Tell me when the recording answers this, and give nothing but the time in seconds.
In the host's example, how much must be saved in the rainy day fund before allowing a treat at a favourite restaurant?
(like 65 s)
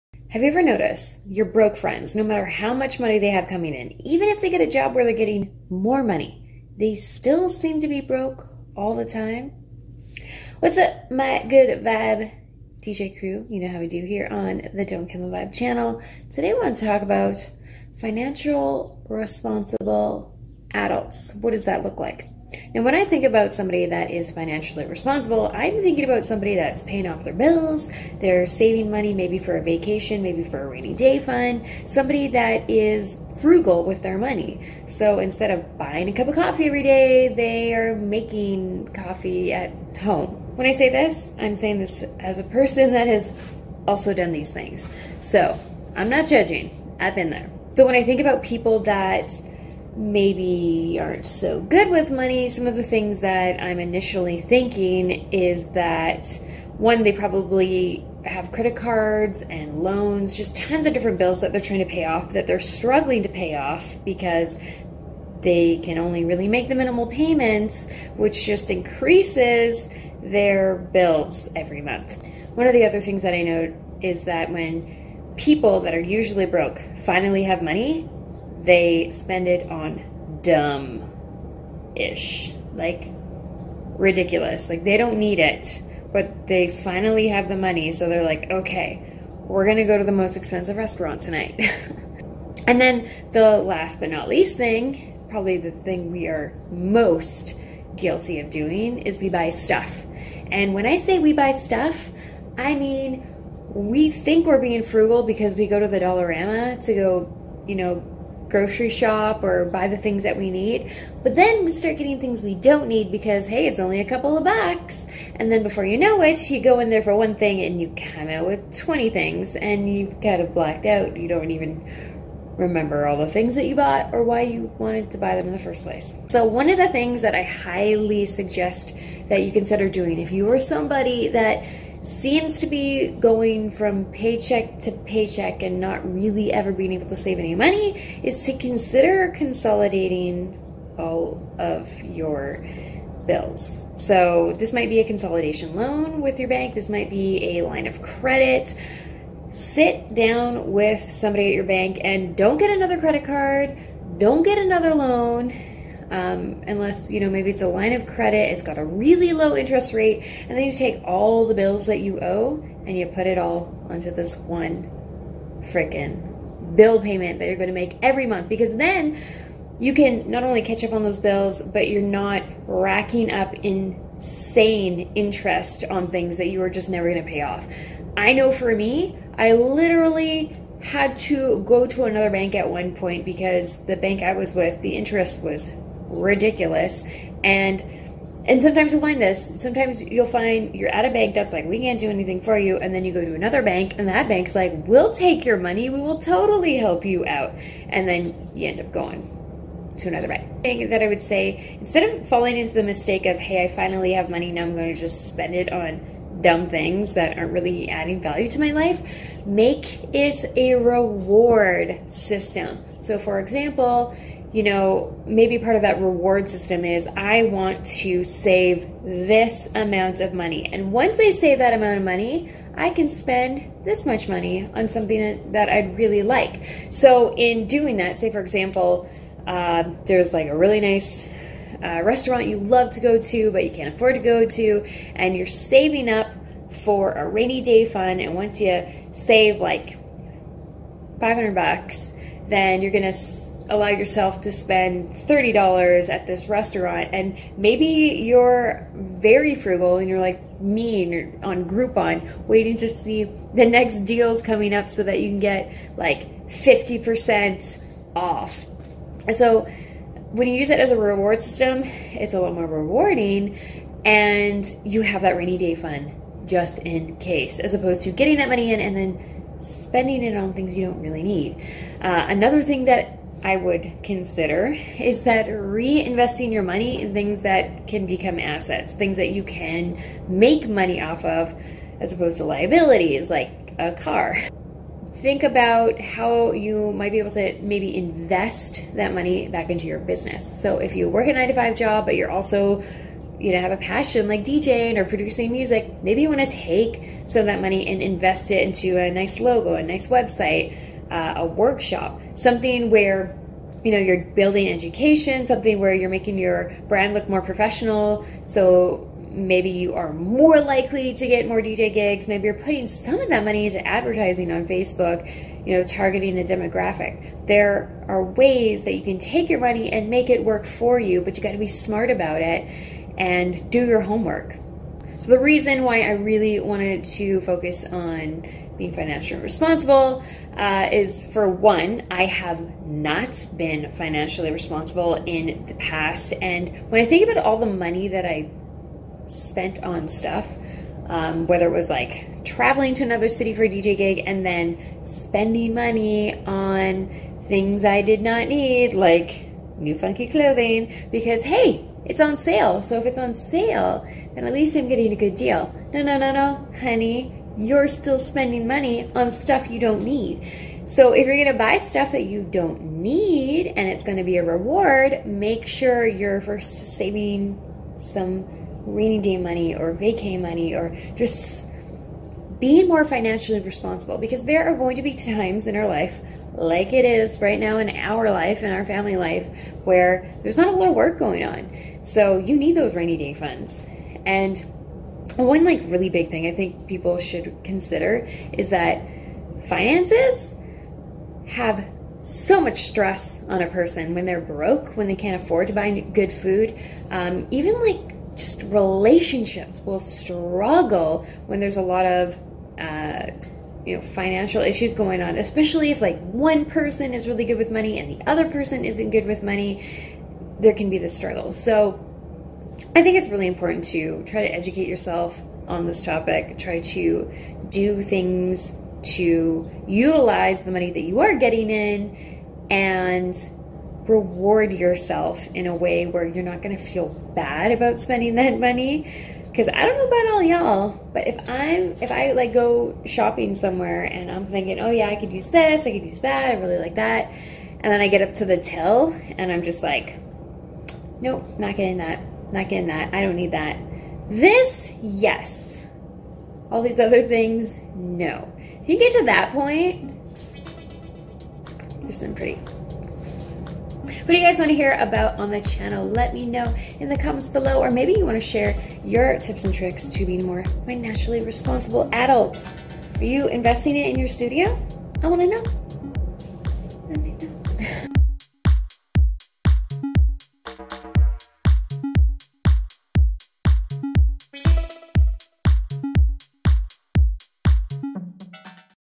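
241 s.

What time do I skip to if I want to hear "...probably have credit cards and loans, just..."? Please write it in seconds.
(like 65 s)
57 s.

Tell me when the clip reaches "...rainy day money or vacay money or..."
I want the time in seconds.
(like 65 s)
368 s.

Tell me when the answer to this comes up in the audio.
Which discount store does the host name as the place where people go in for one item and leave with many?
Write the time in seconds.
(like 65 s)
105 s.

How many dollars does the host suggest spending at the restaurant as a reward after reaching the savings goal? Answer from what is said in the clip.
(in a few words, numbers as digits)
$30.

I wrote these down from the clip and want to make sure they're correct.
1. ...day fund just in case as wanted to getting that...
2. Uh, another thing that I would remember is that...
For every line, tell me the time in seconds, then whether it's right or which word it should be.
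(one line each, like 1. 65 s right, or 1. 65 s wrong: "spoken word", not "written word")
1. 265 s wrong: "opposed", not "wanted"
2. 272 s wrong: "consider", not "remember".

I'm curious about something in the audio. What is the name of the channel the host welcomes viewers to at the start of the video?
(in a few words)
Don't Kilma Vibe.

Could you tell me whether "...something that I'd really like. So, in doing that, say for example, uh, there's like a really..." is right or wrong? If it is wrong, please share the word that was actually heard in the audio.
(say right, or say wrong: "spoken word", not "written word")
right.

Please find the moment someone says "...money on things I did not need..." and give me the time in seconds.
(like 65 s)
345 s.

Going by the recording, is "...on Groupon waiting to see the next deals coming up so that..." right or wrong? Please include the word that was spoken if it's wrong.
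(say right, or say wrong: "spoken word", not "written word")
right.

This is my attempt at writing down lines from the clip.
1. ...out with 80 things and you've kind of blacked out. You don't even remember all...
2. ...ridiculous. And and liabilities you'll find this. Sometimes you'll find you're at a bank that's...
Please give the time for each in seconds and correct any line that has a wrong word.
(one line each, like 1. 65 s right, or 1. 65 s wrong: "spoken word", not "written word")
1. 118 s wrong: "20", not "80"
2. 186 s wrong: "sometimes", not "liabilities".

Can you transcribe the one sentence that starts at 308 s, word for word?
So maybe you are more likely to get more DJ gigs.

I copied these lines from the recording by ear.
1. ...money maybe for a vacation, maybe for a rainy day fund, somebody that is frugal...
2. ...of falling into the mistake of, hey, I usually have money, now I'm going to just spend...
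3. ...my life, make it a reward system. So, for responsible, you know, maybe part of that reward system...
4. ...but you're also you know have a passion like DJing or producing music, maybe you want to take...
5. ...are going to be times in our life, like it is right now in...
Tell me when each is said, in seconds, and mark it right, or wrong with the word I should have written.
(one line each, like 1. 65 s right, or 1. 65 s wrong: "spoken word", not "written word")
1. 28 s right
2. 202 s wrong: "finally", not "usually"
3. 208 s wrong: "example", not "responsible"
4. 292 s right
5. 374 s right.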